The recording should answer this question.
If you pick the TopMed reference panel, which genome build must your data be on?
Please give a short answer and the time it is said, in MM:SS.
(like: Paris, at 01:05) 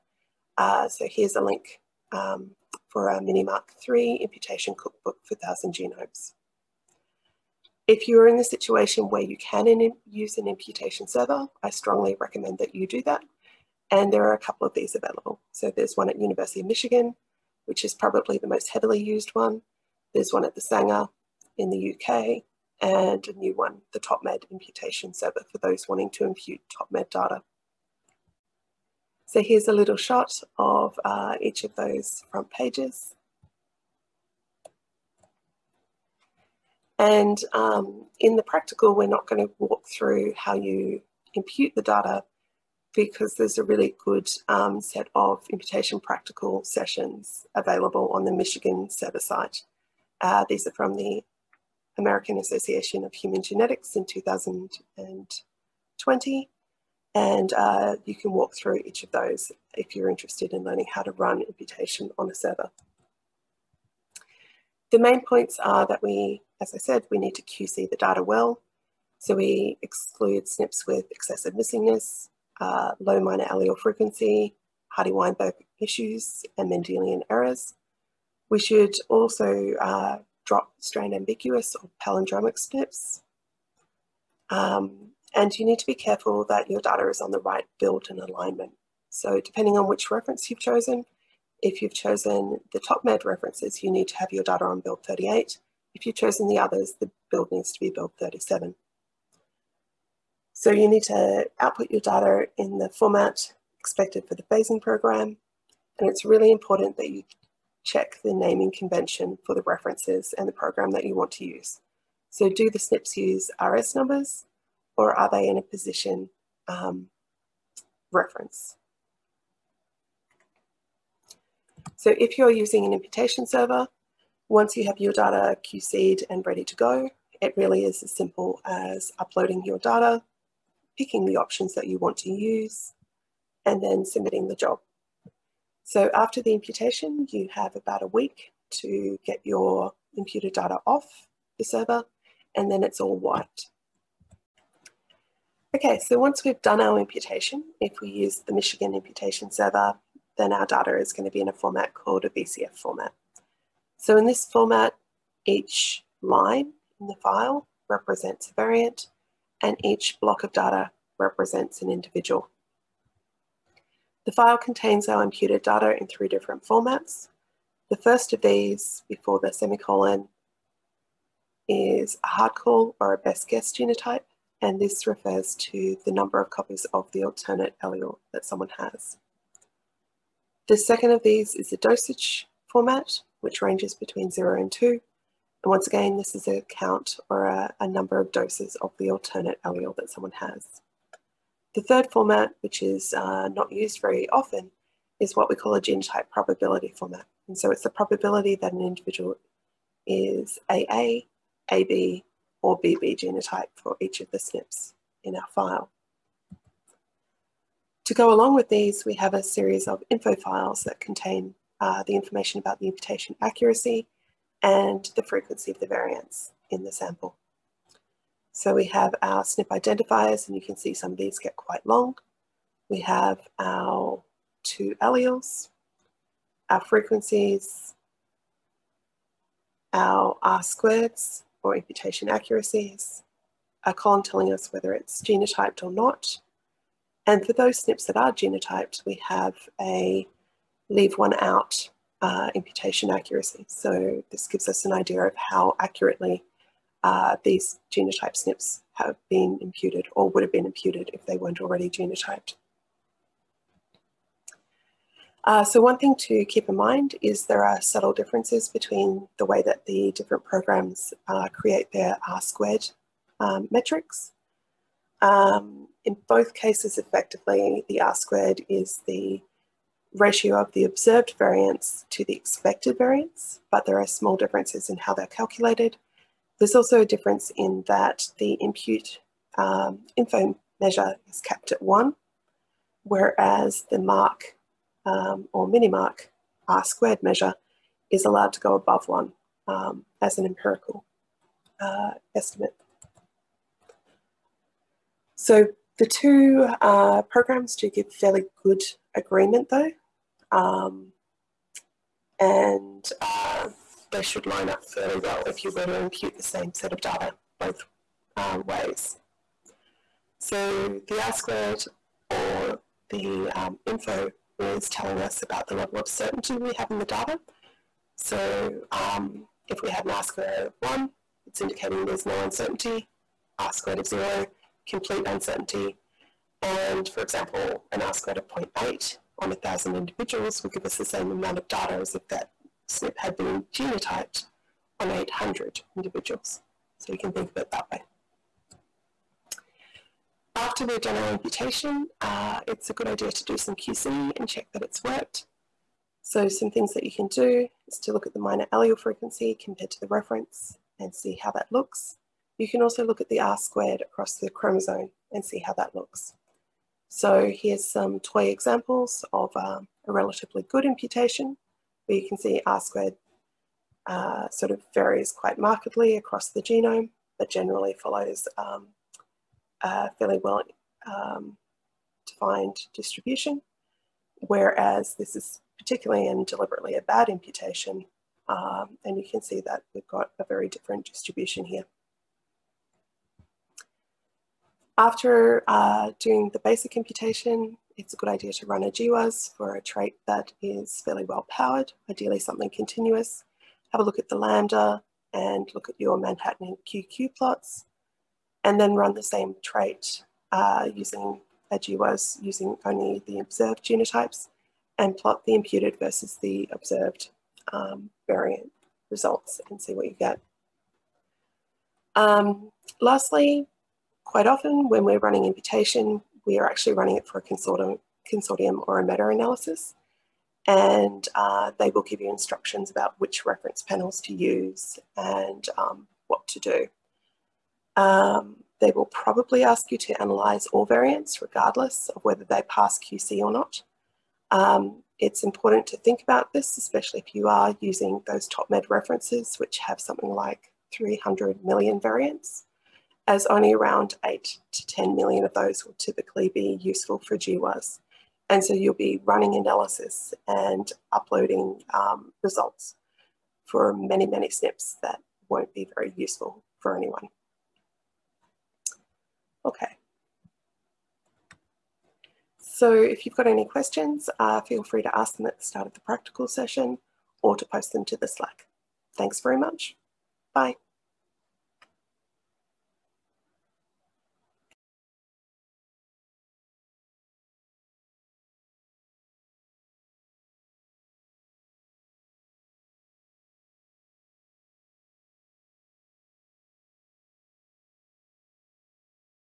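Build 38, at 01:34.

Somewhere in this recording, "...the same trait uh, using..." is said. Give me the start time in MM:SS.
06:39.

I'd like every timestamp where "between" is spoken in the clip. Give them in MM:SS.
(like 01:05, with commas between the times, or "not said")
03:03, 04:18.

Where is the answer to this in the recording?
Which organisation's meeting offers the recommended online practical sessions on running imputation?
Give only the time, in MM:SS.
00:51.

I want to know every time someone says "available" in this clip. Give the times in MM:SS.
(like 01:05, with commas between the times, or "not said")
00:14, 00:47.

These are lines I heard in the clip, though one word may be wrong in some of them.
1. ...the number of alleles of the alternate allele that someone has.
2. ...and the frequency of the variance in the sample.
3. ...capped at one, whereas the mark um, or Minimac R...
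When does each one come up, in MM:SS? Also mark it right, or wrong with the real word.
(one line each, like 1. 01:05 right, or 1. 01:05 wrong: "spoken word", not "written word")
1. 02:56 wrong: "copies", not "alleles"
2. 03:34 right
3. 04:41 right.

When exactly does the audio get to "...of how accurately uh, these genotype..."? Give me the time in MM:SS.
04:05.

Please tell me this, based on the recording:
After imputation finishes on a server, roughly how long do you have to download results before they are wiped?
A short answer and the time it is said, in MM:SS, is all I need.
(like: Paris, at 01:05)
About a week, at 02:17.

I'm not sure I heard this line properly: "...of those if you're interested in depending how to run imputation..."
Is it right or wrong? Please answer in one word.
wrong.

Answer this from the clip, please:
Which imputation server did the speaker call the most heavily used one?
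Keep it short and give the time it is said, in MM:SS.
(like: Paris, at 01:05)
University of Michigan, at 00:16.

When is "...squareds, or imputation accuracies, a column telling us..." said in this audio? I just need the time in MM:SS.
03:50.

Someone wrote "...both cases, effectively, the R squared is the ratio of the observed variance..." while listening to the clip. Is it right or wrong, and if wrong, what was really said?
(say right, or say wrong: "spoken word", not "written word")
right.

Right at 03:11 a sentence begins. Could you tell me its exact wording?
The third format, which is uh, not used very often, is what we call a genotype probability format.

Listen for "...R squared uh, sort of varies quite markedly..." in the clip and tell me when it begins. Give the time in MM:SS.
06:02.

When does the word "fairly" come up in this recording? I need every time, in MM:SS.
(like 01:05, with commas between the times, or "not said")
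04:58, 05:04, 06:10, 06:31.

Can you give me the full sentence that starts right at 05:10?
So the R squared or the um, info is telling us about the level of certainty we have in the data.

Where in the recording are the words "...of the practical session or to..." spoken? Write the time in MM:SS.
07:45.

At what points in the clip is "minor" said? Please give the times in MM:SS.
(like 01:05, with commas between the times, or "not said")
01:13, 05:48.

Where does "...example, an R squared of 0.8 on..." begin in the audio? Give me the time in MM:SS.
05:27.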